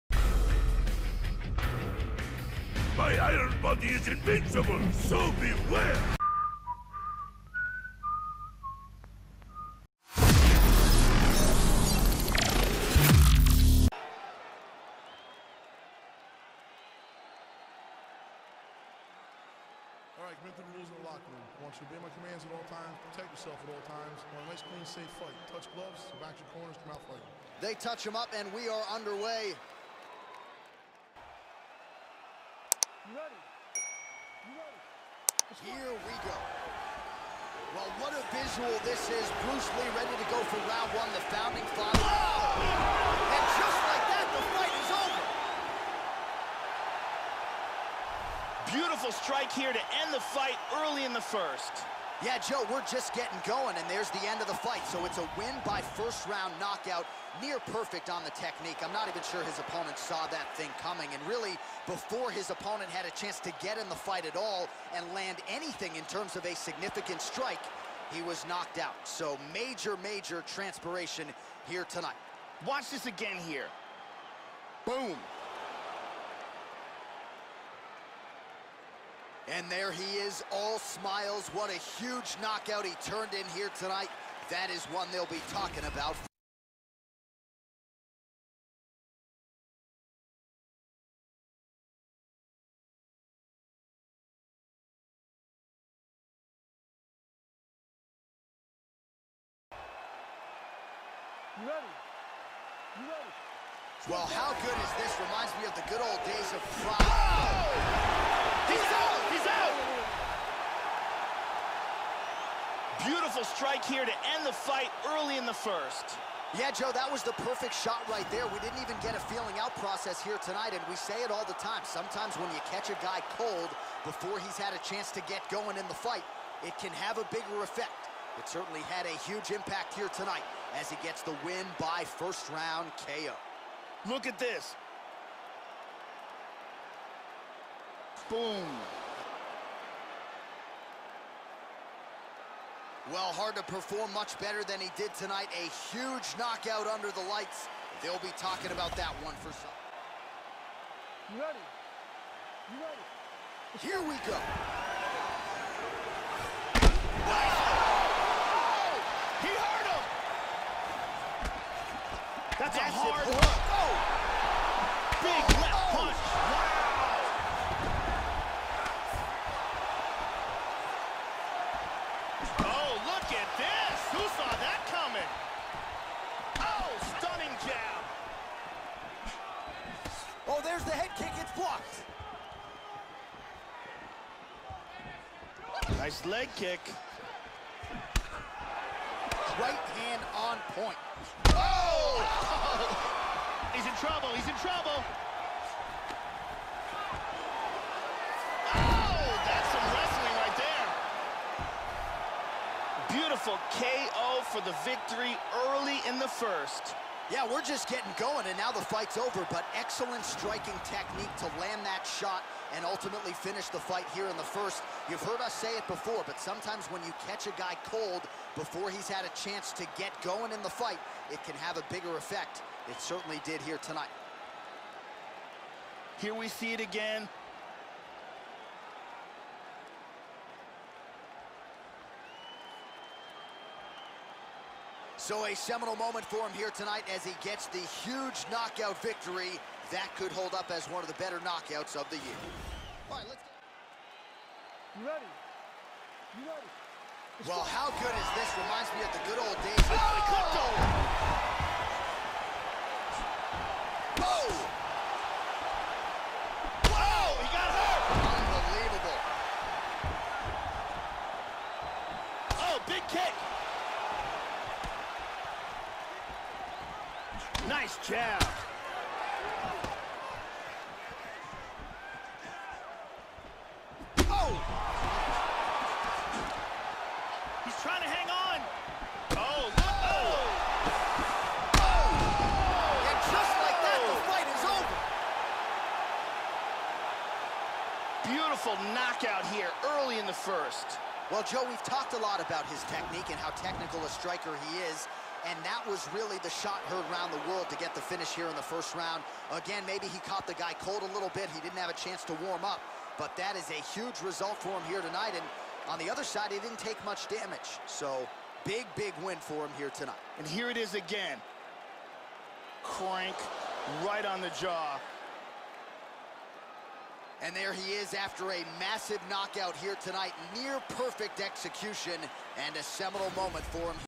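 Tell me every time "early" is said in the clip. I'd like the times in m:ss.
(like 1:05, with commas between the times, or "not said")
0:50, 1:55, 3:25, 4:49.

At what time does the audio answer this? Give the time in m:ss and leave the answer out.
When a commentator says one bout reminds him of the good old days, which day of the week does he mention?
1:46.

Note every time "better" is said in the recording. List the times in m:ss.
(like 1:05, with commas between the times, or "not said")
2:24, 4:01.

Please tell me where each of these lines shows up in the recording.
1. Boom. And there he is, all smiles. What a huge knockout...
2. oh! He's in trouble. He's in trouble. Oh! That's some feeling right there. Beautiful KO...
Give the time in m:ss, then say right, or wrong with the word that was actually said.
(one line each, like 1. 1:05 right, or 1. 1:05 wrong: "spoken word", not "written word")
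1. 1:14 right
2. 3:12 wrong: "wrestling", not "feeling".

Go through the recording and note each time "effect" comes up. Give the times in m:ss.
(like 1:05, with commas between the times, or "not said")
2:07, 3:42.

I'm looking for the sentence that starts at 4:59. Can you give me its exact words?
Again, maybe he caught the guy cold a little bit.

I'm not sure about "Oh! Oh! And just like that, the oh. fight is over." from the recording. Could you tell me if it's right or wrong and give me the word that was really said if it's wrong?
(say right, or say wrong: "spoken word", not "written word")
right.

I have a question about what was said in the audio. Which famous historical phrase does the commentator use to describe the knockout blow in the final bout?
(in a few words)
The shot heard around the world.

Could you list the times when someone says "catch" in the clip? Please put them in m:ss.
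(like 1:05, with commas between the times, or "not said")
2:02, 3:37.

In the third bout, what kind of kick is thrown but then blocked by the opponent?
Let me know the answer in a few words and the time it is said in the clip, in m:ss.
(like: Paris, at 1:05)
Head kick, at 3:00.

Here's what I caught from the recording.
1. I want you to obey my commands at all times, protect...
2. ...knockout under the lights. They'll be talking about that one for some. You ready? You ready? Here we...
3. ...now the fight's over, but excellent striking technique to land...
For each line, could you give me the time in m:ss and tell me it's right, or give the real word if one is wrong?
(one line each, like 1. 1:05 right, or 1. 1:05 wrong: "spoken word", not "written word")
1. 0:21 right
2. 2:26 right
3. 3:28 right.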